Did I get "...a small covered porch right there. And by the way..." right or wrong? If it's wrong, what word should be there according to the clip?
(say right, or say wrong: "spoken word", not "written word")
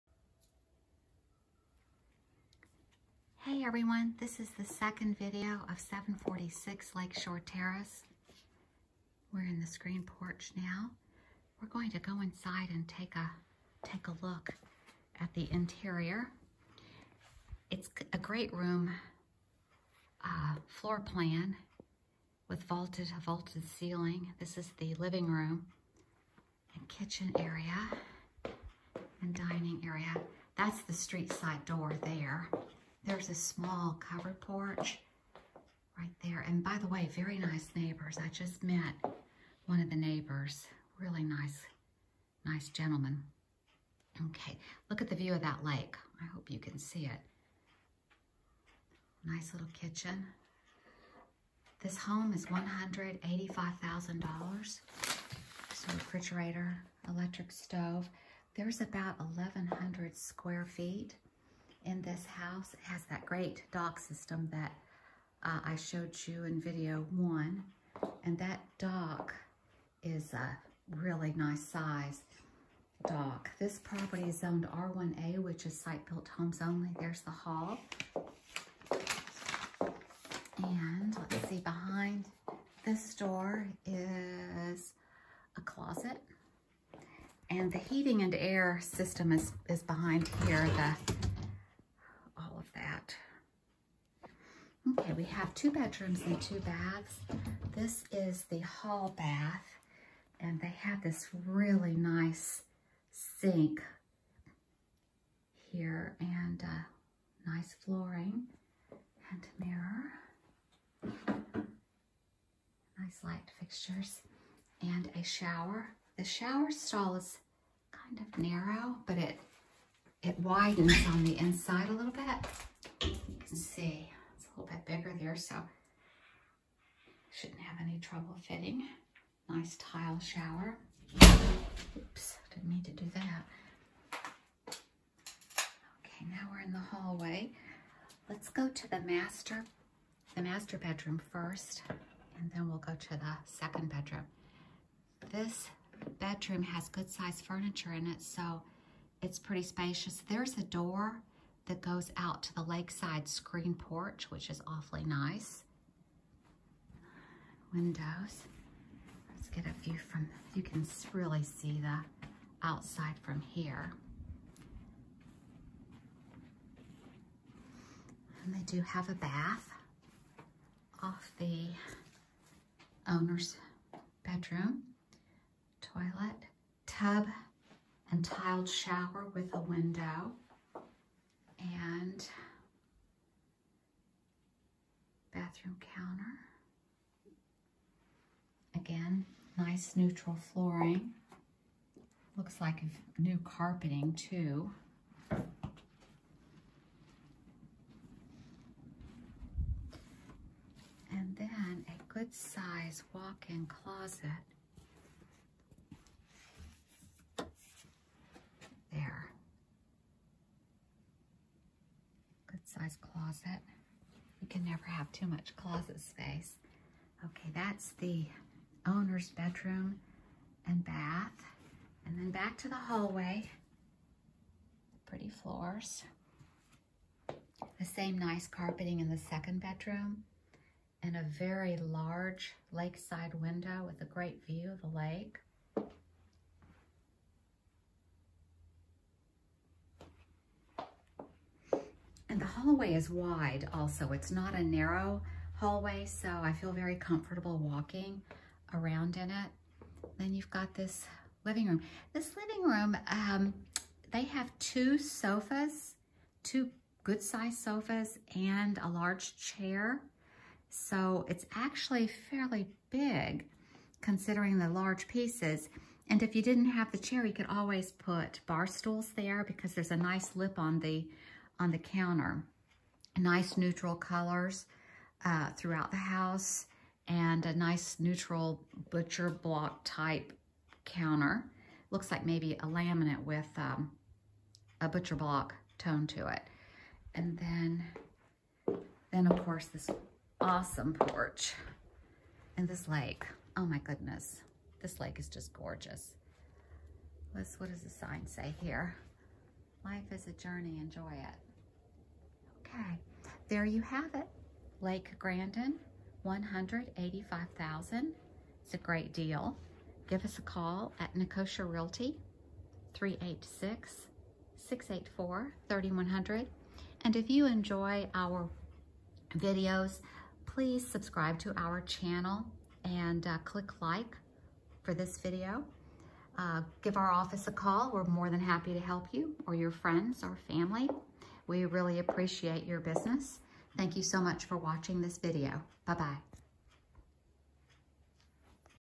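right.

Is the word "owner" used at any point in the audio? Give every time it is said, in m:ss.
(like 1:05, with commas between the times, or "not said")
2:53, 3:38.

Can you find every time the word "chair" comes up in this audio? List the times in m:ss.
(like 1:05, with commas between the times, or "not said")
4:19, 4:26.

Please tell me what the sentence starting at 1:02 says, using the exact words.
It has that great dock system that uh, I showed you in video one.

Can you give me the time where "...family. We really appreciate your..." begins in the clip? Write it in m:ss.
5:30.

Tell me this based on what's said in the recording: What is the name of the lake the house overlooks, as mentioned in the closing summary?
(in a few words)
Lake Grandin.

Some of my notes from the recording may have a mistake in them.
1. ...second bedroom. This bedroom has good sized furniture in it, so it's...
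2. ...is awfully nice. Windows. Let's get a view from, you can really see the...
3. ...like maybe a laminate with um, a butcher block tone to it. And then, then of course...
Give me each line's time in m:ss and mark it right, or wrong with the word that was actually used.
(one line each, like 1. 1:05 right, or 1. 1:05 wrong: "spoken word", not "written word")
1. 2:23 right
2. 2:34 right
3. 4:42 right.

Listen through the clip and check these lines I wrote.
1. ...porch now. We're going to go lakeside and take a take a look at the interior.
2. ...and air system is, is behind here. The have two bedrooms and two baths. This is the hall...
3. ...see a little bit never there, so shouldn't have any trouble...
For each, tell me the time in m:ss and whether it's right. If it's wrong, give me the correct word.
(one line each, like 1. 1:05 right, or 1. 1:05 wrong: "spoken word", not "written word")
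1. 0:10 wrong: "inside", not "lakeside"
2. 1:28 right
3. 2:03 wrong: "bigger", not "never".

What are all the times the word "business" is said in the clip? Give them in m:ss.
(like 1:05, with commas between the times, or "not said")
5:32.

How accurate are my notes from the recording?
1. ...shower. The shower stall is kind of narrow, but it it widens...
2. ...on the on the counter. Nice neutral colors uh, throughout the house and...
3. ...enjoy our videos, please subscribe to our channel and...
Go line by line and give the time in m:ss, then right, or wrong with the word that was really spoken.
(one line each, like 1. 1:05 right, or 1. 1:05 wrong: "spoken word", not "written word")
1. 1:55 right
2. 4:30 right
3. 5:17 right.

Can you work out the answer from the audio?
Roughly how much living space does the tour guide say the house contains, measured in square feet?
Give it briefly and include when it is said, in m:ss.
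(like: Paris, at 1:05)
1,100, at 0:59.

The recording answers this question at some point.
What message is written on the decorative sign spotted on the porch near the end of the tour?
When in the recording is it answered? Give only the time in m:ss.
4:59.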